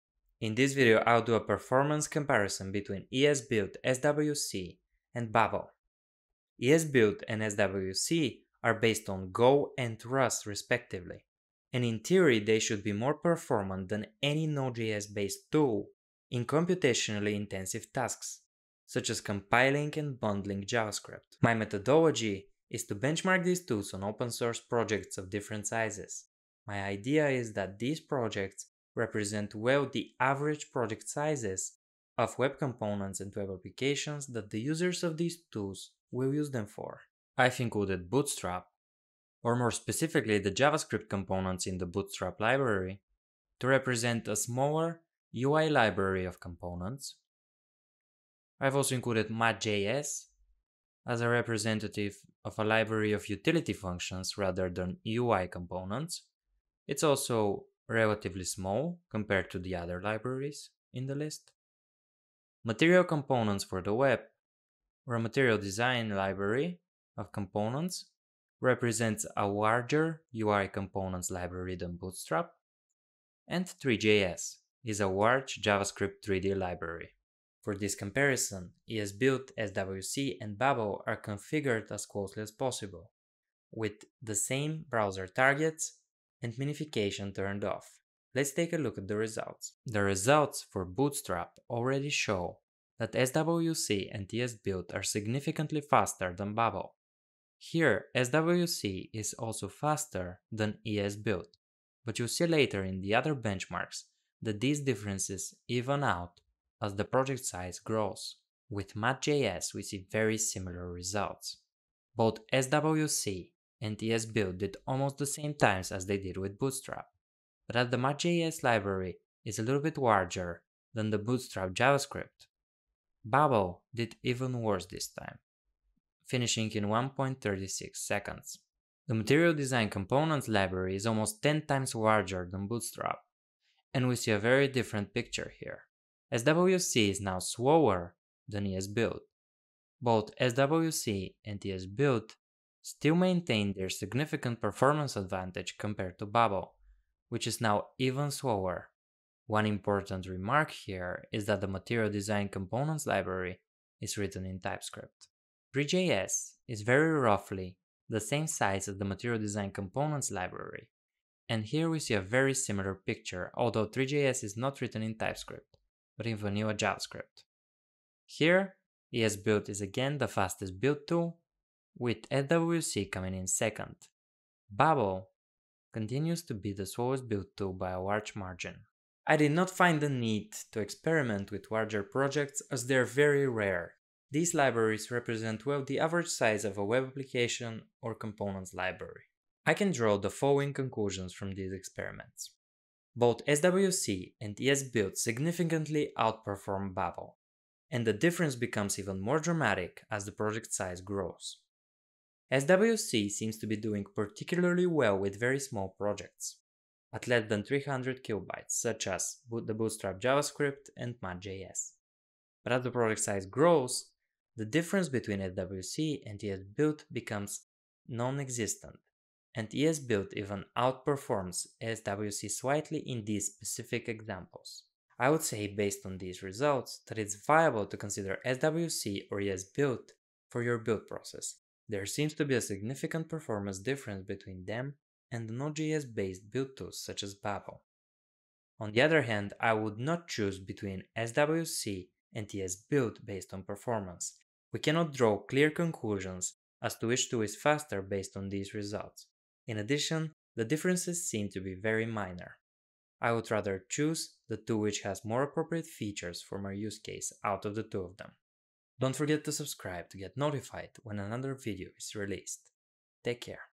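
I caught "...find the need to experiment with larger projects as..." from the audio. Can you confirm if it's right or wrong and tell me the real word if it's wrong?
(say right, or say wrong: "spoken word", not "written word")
right.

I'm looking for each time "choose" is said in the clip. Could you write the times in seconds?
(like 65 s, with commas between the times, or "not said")
240 s, 253 s.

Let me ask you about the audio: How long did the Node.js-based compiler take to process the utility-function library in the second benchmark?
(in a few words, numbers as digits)
1.36 seconds.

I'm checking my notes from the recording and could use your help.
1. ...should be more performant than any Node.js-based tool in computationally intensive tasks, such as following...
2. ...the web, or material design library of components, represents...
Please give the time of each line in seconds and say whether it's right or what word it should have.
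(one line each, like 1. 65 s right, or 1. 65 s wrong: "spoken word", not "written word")
1. 12 s wrong: "compiling", not "following"
2. 63 s right.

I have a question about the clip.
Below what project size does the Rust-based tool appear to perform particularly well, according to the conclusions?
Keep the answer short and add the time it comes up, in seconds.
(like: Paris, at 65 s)
300 kilobytes, at 207 s.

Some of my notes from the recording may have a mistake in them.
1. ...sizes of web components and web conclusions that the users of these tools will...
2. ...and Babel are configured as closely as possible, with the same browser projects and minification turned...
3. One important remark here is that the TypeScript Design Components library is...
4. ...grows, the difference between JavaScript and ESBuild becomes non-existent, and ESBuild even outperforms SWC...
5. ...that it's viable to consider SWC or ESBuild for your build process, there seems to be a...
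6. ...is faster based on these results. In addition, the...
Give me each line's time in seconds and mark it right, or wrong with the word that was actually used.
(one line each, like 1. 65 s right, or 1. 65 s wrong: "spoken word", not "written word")
1. 31 s wrong: "applications", not "conclusions"
2. 80 s wrong: "targets", not "projects"
3. 149 s wrong: "Material", not "TypeScript"
4. 213 s wrong: "SWC", not "JavaScript"
5. 227 s right
6. 247 s right.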